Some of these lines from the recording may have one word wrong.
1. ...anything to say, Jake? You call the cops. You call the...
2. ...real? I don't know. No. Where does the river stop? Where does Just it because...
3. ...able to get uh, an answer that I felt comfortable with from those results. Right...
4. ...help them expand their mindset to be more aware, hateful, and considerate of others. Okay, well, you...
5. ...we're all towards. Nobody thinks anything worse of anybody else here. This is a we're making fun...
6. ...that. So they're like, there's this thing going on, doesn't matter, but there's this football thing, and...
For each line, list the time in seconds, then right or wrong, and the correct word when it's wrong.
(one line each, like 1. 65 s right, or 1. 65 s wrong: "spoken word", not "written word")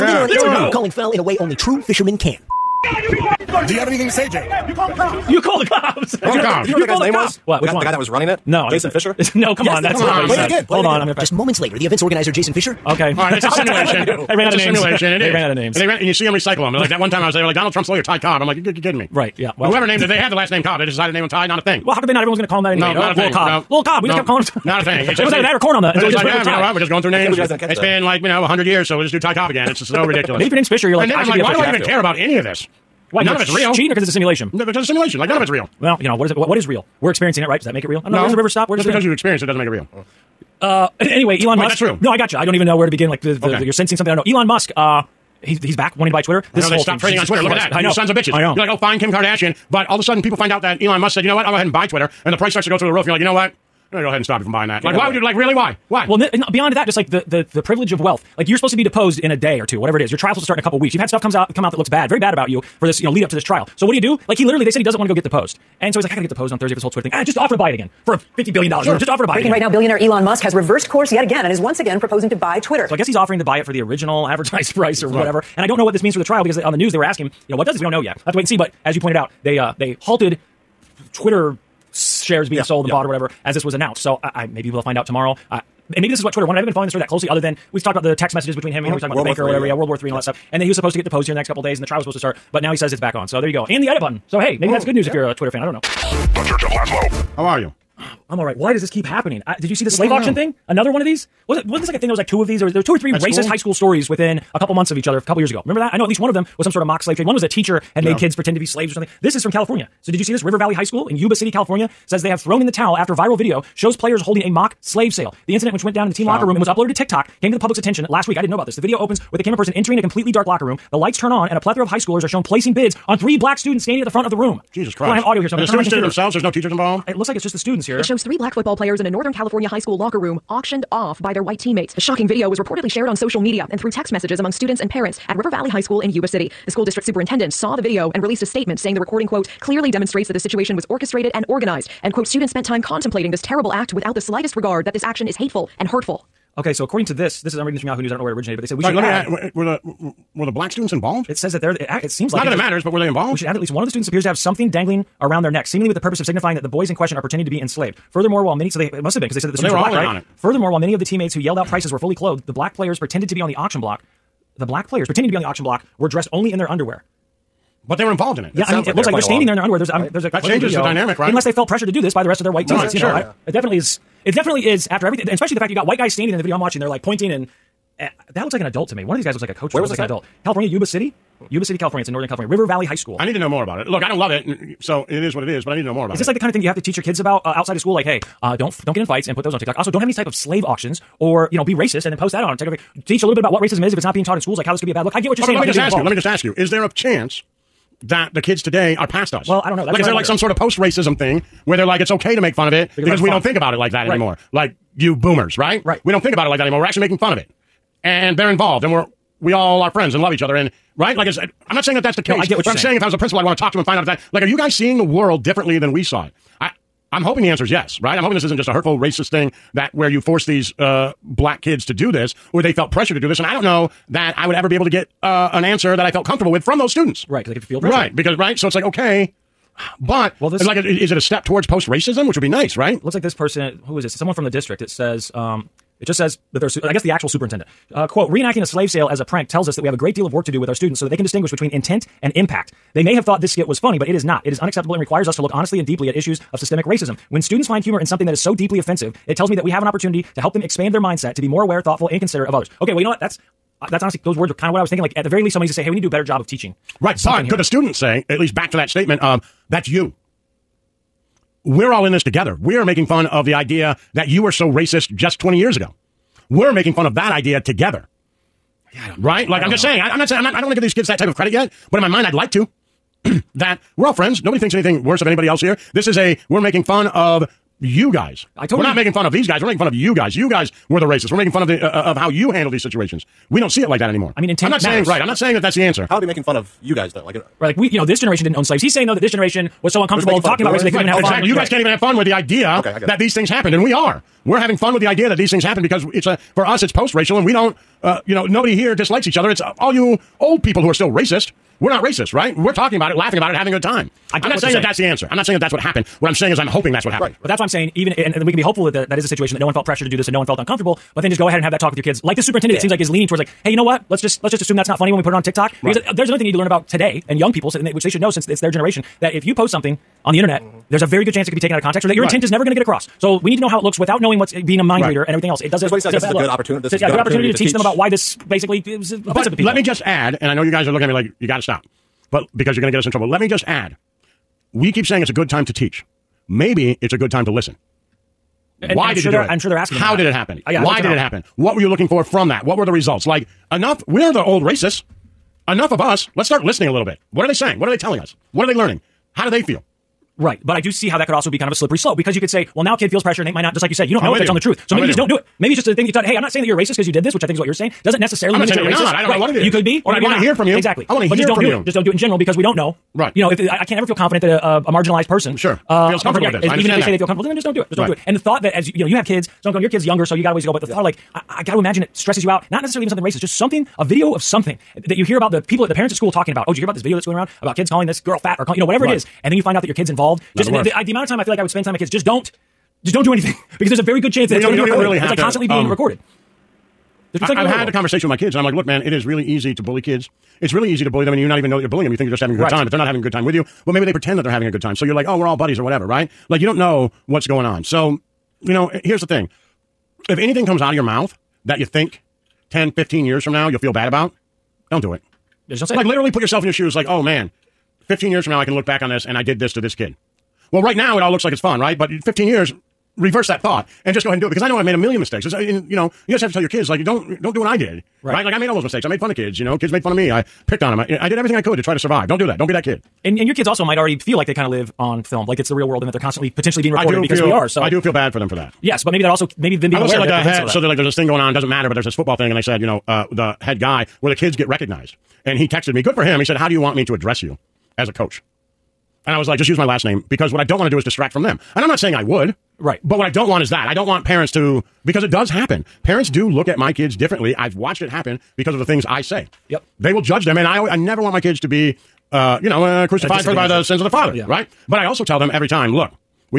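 1. 3 s right
2. 37 s right
3. 224 s wrong: "students", not "results"
4. 250 s wrong: "thoughtful", not "hateful"
5. 273 s wrong: "friends", not "towards"
6. 430 s right.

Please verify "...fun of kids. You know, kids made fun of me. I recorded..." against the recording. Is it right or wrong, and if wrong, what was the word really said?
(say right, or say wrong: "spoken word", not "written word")
wrong: "picked", not "recorded".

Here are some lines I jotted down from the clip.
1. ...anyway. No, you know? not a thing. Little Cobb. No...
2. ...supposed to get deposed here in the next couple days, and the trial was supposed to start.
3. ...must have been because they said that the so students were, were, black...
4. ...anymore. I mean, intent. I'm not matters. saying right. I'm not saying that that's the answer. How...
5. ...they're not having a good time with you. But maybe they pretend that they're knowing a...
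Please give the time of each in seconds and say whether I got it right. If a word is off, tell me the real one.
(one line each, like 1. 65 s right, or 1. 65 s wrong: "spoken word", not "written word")
1. 22 s right
2. 90 s right
3. 159 s right
4. 284 s right
5. 392 s wrong: "having", not "knowing".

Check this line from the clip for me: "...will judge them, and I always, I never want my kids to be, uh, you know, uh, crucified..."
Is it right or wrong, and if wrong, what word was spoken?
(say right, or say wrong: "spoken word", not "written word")
right.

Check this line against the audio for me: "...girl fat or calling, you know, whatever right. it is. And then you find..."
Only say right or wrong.
right.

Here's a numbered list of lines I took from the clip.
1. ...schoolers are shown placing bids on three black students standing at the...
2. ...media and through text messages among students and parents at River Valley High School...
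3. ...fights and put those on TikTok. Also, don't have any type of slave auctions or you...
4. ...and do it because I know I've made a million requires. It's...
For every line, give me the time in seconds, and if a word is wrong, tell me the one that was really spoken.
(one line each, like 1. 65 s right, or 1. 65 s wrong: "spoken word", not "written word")
1. 121 s right
2. 133 s right
3. 189 s right
4. 414 s wrong: "mistakes", not "requires".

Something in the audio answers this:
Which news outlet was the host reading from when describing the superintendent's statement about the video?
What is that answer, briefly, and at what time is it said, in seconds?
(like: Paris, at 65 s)
Yahoo News, at 147 s.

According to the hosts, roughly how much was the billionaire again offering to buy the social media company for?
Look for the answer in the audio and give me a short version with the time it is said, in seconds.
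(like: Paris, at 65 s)
50 billion dollars, at 68 s.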